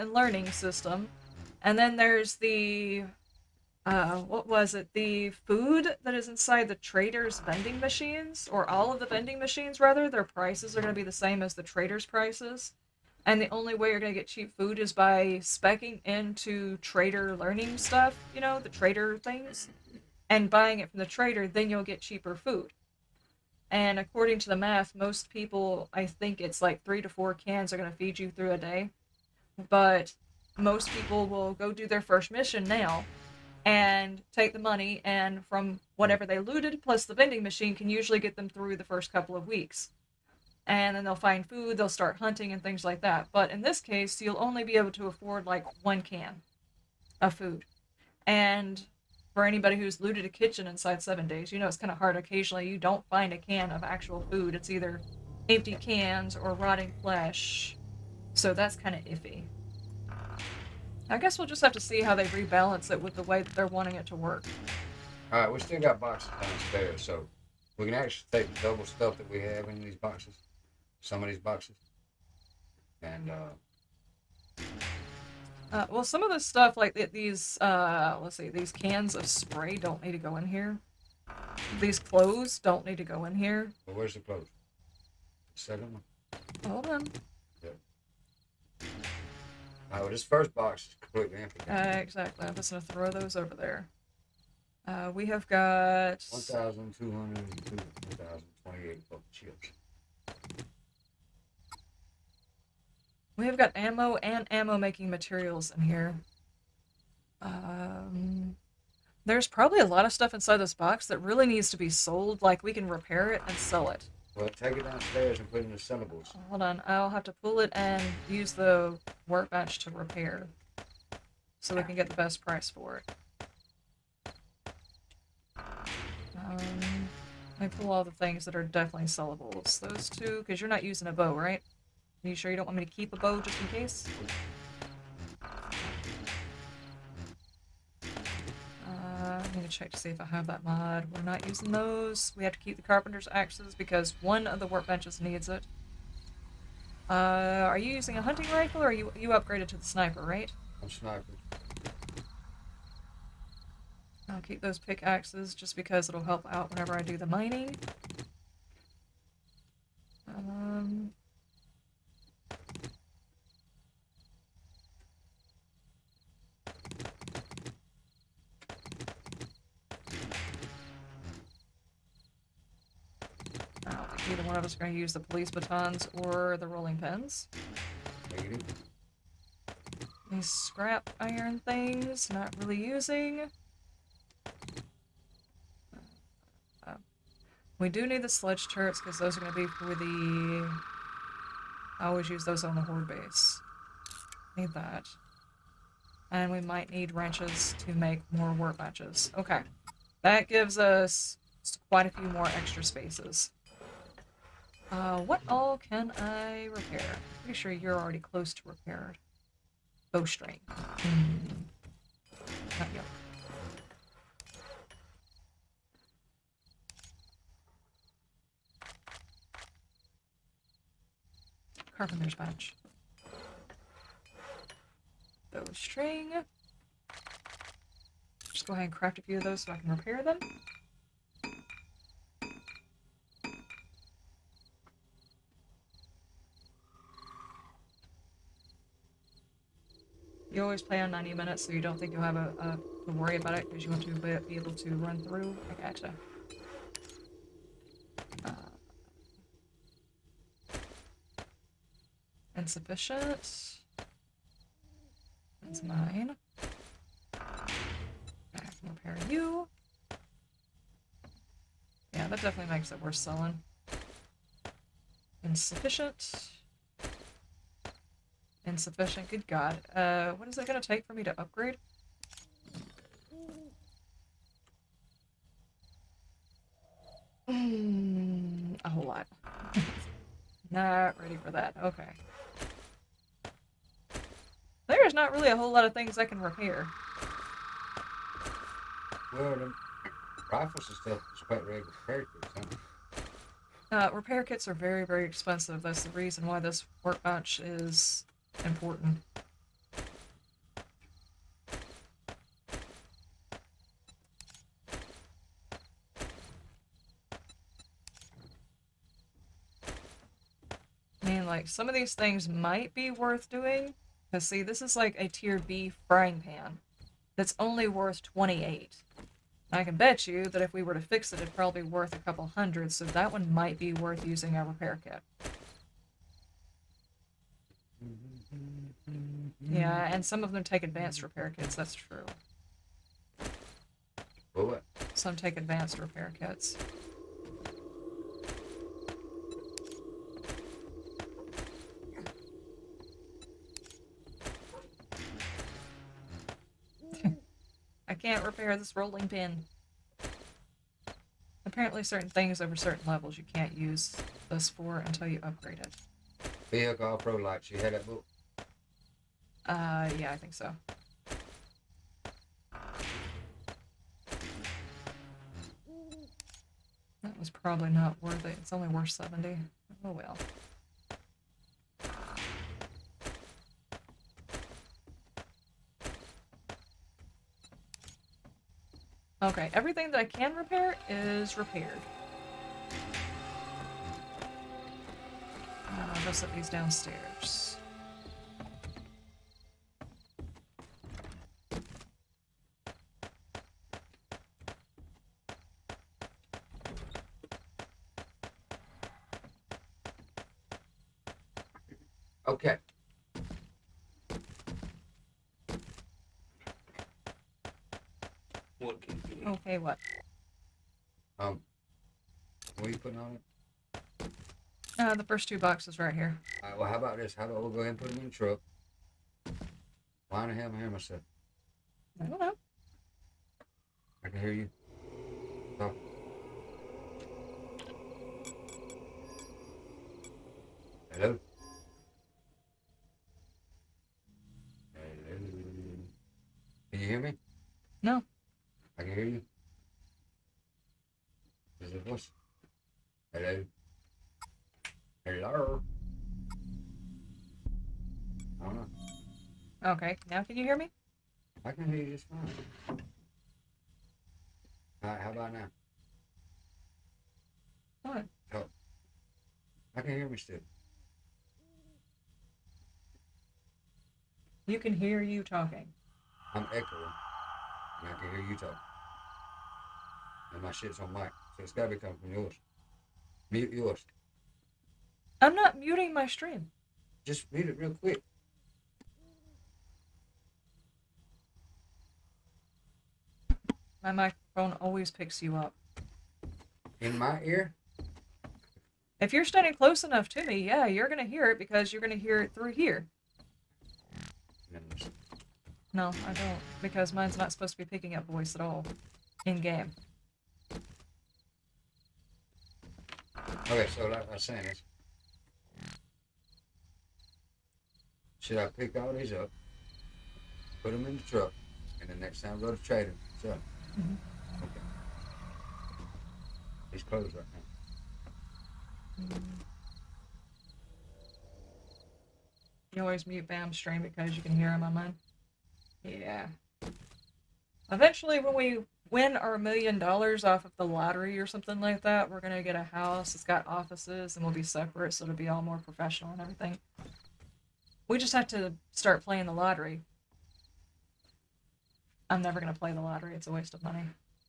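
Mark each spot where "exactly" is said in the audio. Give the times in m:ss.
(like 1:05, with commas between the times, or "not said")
1:31.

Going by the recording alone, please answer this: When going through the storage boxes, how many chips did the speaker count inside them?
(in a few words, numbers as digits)
1,202.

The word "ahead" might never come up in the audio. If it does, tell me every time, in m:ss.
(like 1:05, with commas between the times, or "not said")
3:48, 6:57.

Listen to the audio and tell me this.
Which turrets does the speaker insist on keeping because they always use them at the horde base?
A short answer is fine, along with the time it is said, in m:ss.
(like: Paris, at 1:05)
Sledge turrets, at 3:08.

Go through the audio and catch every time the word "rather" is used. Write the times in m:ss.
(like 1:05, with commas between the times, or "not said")
0:09.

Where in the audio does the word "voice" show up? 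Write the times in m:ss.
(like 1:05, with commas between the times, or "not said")
8:18.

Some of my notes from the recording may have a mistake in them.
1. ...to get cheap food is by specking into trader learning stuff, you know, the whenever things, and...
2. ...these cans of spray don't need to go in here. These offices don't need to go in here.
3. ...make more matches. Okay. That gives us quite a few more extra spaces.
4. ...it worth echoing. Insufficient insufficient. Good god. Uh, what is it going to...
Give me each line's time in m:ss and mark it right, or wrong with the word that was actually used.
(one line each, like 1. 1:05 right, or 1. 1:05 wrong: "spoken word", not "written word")
1. 0:14 wrong: "trader", not "whenever"
2. 1:18 wrong: "clothes", not "offices"
3. 3:17 right
4. 4:22 wrong: "selling", not "echoing".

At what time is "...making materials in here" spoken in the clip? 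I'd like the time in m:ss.
1:44.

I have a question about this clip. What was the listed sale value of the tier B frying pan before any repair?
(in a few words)
28.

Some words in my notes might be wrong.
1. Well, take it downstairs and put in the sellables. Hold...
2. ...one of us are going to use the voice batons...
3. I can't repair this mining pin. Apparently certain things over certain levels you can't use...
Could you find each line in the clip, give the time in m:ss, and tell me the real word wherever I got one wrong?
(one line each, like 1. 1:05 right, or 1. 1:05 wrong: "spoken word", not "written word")
1. 1:54 right
2. 2:54 wrong: "police", not "voice"
3. 5:48 wrong: "rolling", not "mining".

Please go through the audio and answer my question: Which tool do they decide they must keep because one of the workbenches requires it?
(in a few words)
Carpenter's axes.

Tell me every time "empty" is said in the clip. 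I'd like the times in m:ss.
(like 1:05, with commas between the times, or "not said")
0:55, 1:31.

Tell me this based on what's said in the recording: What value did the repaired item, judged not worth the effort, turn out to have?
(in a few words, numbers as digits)
70.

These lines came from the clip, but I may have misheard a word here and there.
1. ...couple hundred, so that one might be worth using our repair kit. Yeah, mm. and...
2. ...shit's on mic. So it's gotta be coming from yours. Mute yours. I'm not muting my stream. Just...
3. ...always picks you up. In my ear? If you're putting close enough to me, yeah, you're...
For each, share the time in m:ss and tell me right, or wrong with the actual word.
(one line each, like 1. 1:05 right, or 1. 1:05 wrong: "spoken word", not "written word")
1. 5:22 right
2. 7:50 right
3. 8:04 wrong: "standing", not "putting".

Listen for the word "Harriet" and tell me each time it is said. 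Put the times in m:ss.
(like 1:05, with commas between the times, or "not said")
not said.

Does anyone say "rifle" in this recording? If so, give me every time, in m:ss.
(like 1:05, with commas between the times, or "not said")
2:28, 4:50.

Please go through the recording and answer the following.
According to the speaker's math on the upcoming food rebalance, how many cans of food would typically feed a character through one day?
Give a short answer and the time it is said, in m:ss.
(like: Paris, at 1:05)
3 to 4, at 0:26.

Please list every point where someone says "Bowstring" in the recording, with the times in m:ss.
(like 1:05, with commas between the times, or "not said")
3:30, 3:45.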